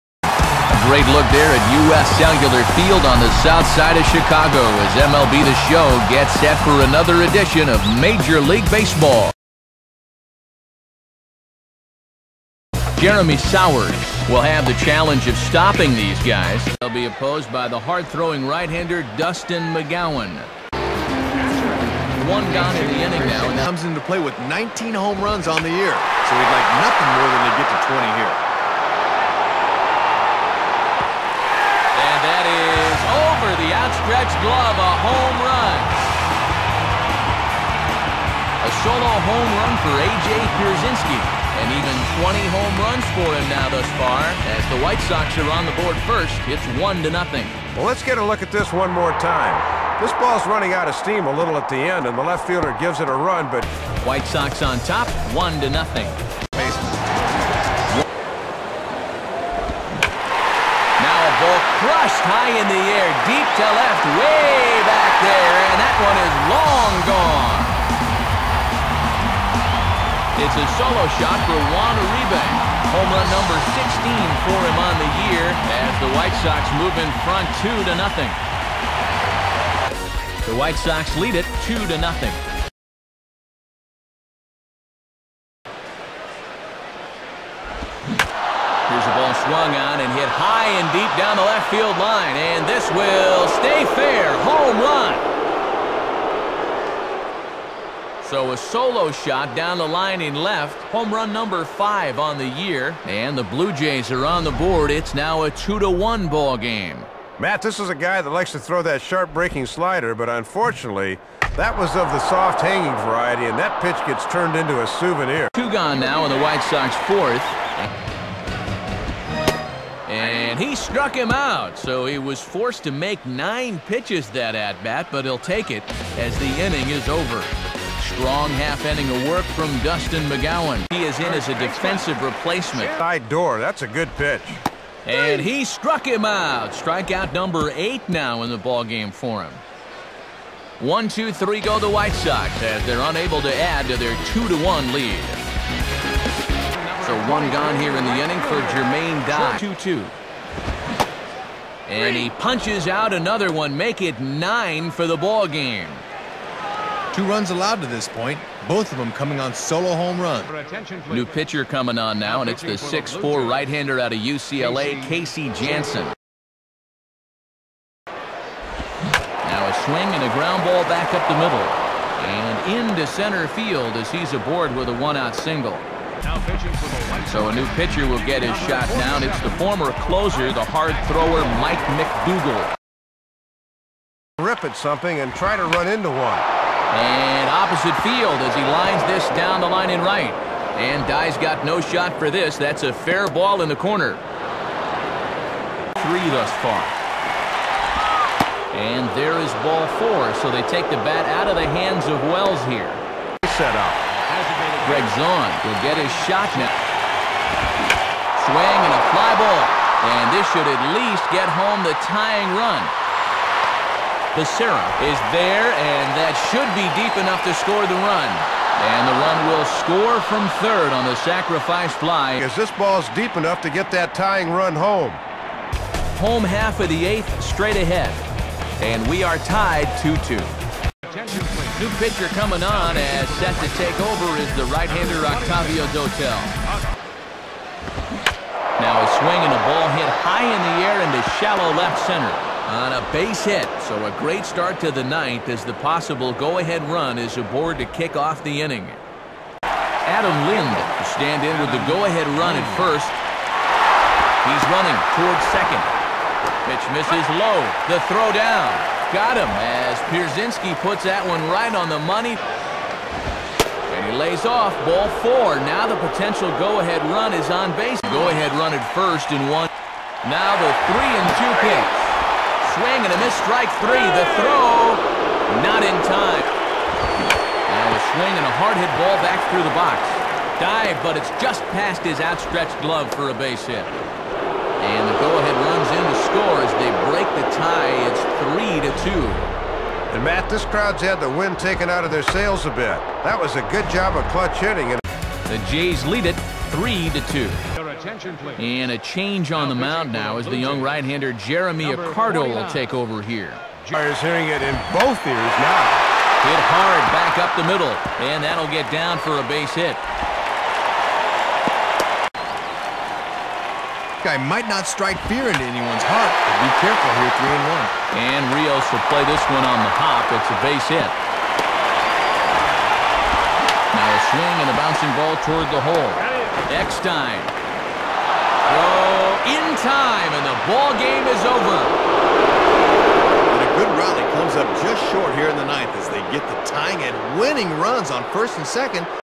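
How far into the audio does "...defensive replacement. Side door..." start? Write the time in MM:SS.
02:11.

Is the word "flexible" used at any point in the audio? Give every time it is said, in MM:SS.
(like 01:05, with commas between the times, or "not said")
not said.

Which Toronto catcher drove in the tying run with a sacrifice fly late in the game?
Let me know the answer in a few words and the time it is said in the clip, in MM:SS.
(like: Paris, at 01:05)
Gregg Zaun, at 03:24.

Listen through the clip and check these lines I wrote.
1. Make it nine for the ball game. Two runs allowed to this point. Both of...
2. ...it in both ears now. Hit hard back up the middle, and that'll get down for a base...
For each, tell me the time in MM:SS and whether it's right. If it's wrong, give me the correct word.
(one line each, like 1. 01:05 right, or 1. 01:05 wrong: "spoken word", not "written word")
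1. 02:33 right
2. 05:04 right.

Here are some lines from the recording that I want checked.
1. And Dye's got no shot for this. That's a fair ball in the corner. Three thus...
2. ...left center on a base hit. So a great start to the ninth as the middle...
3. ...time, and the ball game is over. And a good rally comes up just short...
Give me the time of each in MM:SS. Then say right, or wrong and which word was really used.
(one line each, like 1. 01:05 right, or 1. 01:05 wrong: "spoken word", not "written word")
1. 03:10 right
2. 04:01 wrong: "possible", not "middle"
3. 05:29 right.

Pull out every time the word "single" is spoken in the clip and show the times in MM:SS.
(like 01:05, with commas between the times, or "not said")
02:55.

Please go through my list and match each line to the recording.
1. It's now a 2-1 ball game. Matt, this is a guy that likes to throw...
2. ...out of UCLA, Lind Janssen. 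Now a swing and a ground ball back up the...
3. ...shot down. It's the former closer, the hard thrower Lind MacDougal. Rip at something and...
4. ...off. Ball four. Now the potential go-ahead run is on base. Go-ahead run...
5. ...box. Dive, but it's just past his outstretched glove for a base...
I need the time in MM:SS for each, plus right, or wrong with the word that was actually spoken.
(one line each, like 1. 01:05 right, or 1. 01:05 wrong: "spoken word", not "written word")
1. 01:44 right
2. 02:43 wrong: "Casey", not "Lind"
3. 02:58 wrong: "Mike", not "Lind"
4. 04:24 right
5. 04:39 right.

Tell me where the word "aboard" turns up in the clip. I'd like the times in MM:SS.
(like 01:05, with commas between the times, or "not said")
02:54, 04:07.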